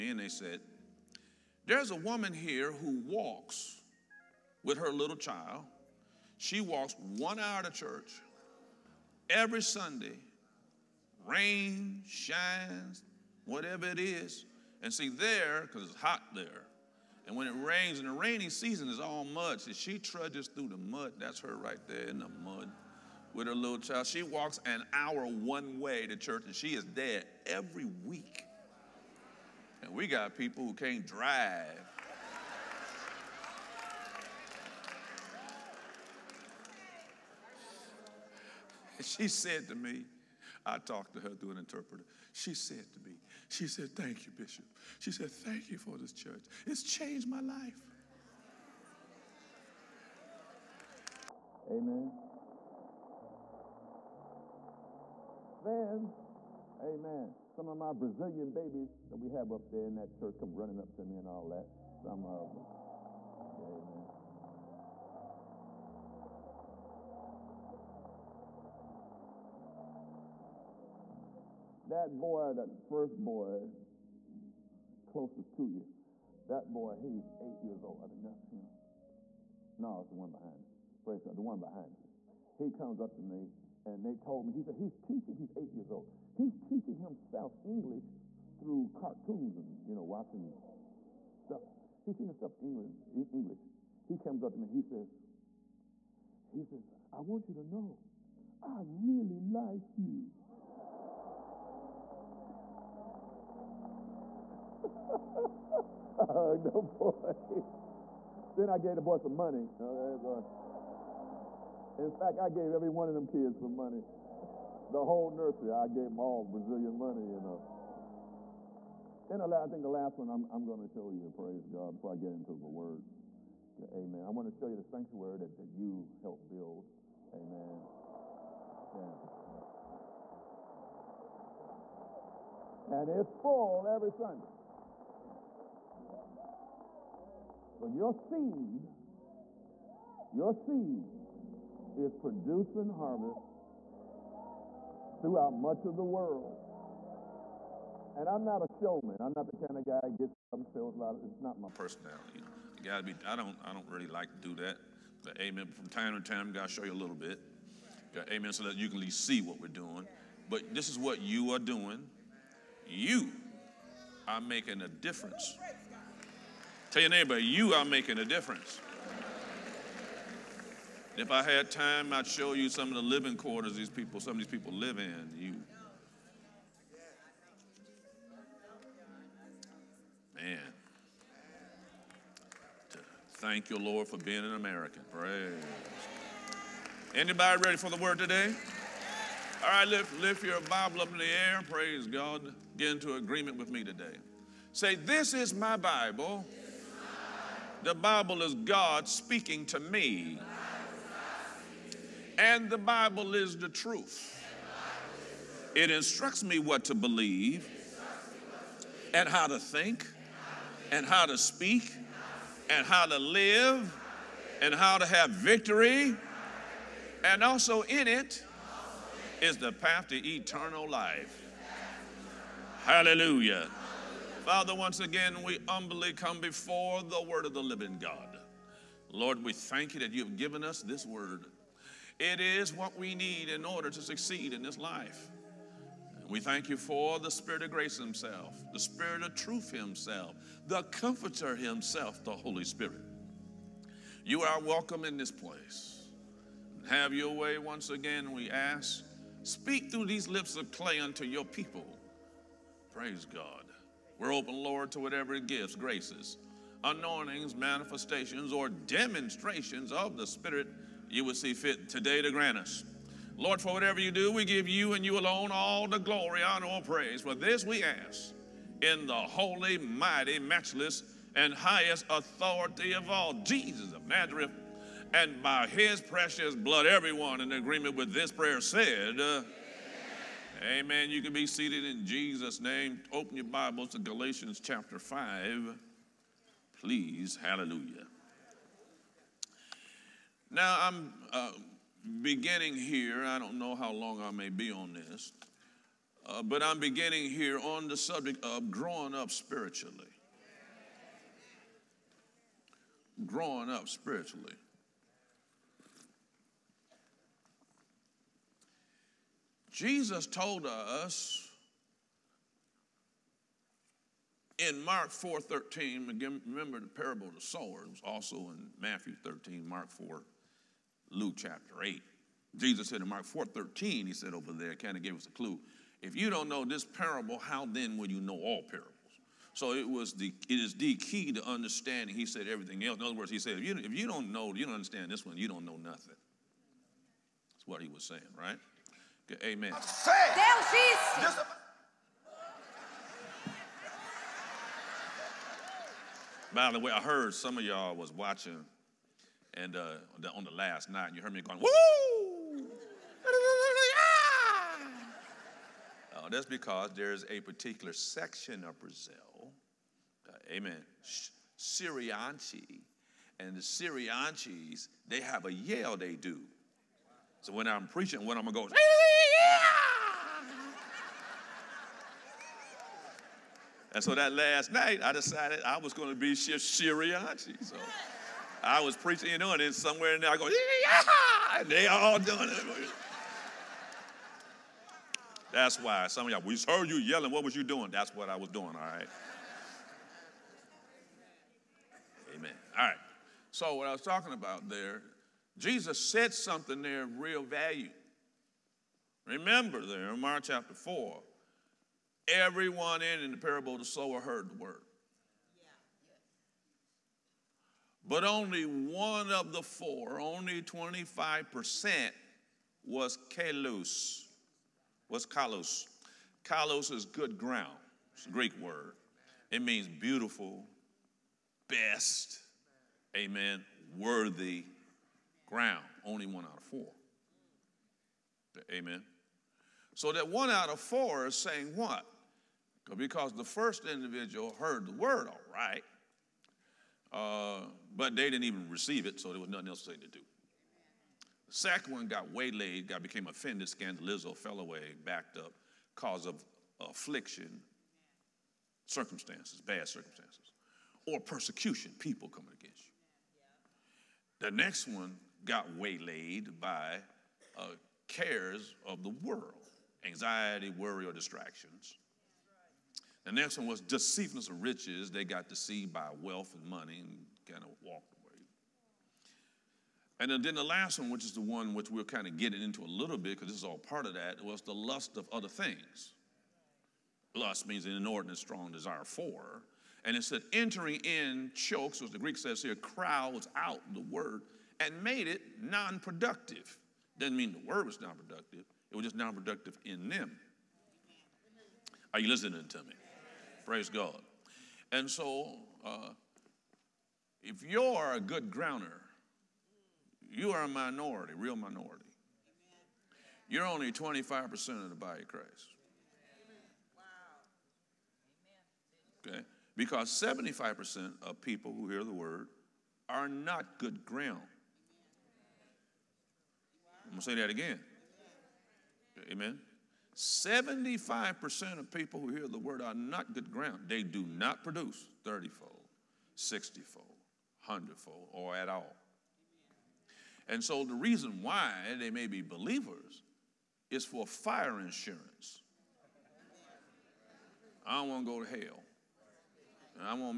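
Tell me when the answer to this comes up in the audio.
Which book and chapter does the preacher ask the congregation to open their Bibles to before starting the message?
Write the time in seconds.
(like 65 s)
283 s.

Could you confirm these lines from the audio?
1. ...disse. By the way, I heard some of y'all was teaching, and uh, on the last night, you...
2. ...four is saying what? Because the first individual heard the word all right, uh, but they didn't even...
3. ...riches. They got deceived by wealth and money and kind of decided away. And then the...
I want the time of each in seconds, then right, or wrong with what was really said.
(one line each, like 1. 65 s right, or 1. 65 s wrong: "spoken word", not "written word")
1. 341 s wrong: "watching", not "teaching"
2. 430 s right
3. 464 s wrong: "walked", not "decided".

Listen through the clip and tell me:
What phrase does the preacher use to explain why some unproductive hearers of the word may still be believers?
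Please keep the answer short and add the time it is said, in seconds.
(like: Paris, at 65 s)
Fire insurance, at 534 s.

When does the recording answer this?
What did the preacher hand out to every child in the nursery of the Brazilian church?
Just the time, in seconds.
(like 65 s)
116 s.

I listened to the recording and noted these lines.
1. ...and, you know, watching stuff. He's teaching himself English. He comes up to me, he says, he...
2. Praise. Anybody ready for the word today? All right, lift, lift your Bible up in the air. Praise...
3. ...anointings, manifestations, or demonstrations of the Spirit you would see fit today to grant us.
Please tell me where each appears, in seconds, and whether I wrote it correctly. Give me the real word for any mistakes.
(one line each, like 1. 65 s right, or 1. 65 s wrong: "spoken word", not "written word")
1. 89 s right
2. 185 s right
3. 256 s right.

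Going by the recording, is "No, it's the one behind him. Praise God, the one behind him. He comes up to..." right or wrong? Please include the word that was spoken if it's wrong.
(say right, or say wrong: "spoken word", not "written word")
right.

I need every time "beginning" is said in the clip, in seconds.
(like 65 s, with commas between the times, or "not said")
292 s, 296 s.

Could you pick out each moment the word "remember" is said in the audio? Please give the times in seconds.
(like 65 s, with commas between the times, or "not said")
316 s, 399 s.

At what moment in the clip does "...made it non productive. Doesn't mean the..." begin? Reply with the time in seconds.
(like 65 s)
485 s.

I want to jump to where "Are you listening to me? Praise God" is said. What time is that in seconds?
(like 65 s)
492 s.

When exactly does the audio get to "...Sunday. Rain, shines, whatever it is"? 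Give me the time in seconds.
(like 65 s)
9 s.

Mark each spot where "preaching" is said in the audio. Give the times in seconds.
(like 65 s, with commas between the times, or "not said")
367 s, 378 s.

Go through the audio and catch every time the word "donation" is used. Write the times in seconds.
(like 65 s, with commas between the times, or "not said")
not said.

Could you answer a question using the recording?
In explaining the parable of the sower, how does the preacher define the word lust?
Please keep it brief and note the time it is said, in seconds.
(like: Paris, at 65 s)
An inordinate strong desire, at 477 s.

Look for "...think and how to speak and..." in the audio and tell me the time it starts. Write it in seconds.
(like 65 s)
209 s.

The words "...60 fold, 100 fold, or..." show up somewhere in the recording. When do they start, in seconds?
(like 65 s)
526 s.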